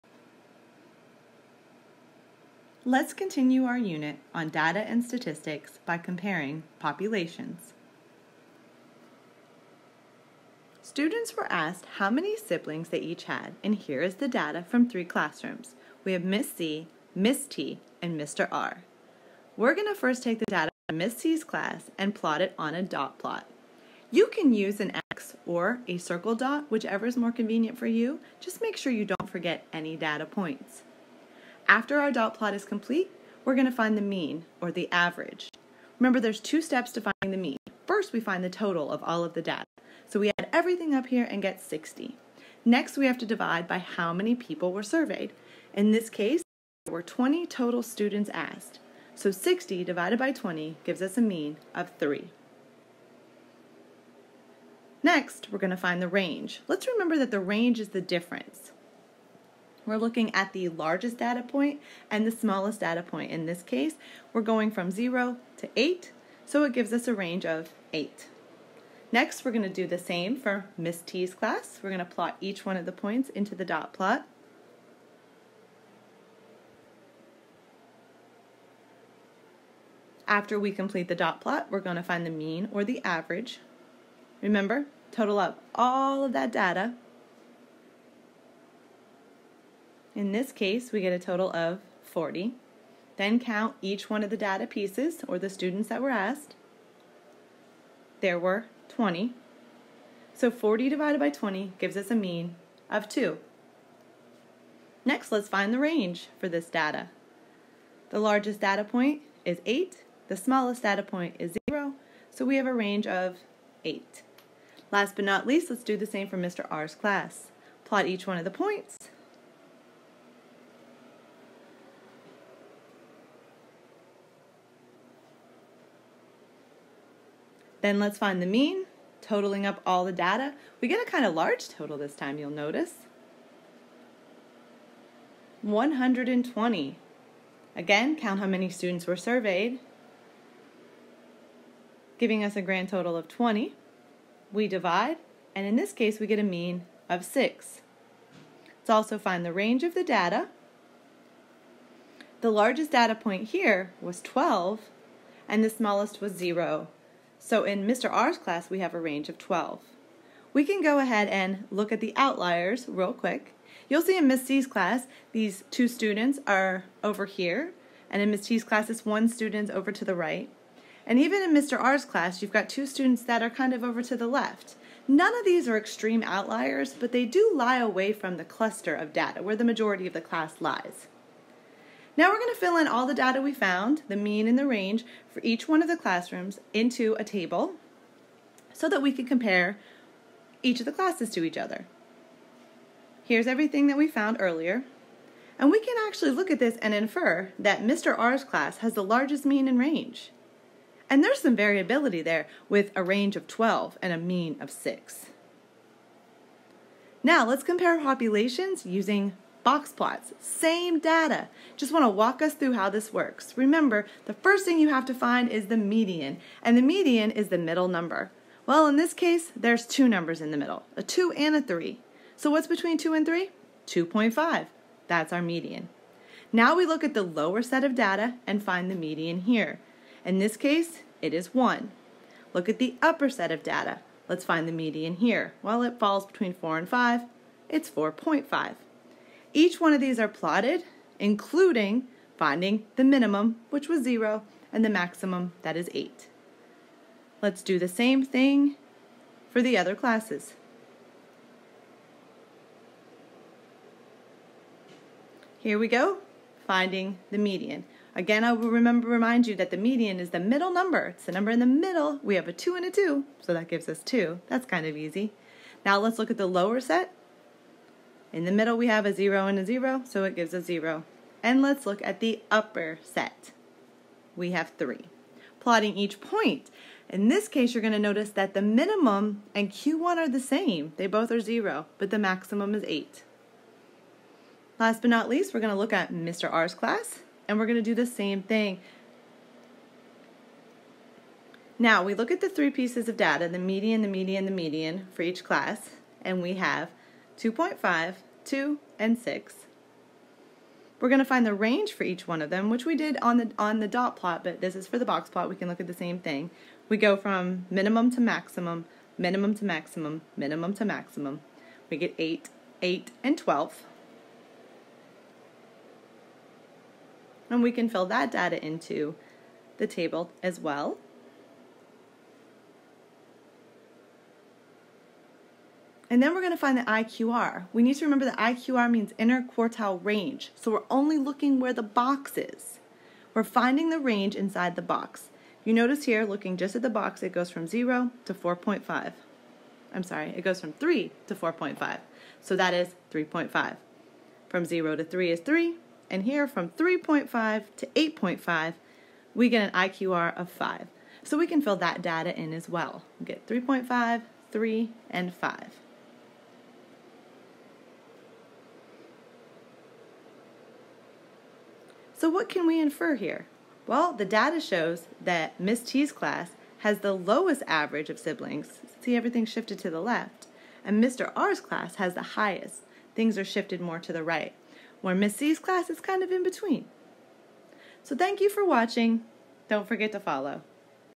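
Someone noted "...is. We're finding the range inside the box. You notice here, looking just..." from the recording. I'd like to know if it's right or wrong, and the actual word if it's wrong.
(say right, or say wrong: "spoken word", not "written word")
right.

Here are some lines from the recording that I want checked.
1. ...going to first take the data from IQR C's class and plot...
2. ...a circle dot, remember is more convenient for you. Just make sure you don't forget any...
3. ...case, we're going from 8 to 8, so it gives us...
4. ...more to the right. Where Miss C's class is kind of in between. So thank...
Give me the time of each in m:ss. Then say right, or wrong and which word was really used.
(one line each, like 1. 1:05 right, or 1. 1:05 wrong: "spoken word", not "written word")
1. 0:19 wrong: "Miss", not "IQR"
2. 0:25 wrong: "whichever", not "remember"
3. 1:03 wrong: "0", not "8"
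4. 6:13 right.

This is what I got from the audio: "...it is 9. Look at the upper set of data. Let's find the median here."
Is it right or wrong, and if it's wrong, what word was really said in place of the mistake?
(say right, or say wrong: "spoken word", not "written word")
wrong: "1", not "9".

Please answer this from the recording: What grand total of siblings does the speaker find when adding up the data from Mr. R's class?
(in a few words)
120.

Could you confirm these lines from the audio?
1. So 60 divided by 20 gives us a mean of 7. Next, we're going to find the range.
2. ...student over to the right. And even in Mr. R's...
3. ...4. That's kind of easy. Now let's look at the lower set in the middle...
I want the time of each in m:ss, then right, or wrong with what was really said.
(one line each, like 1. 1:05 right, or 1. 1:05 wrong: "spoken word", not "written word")
1. 0:49 wrong: "3", not "7"
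2. 2:49 right
3. 4:24 wrong: "2", not "4".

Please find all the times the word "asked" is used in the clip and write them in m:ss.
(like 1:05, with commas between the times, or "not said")
0:11, 0:48, 1:36.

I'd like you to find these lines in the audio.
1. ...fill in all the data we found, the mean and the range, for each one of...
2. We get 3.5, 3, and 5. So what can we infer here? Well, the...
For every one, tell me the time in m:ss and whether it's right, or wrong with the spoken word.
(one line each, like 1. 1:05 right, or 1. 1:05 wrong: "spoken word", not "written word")
1. 3:02 right
2. 5:53 right.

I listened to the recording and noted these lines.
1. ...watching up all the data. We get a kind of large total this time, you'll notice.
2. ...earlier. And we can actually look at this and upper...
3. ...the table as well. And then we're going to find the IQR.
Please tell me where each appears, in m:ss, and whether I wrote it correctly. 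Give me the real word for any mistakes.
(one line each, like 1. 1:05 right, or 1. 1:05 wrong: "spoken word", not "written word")
1. 2:09 wrong: "totaling", not "watching"
2. 3:14 wrong: "infer", not "upper"
3. 5:19 right.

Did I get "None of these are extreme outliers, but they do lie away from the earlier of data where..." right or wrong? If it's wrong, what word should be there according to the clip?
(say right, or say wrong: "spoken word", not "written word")
wrong: "cluster", not "earlier".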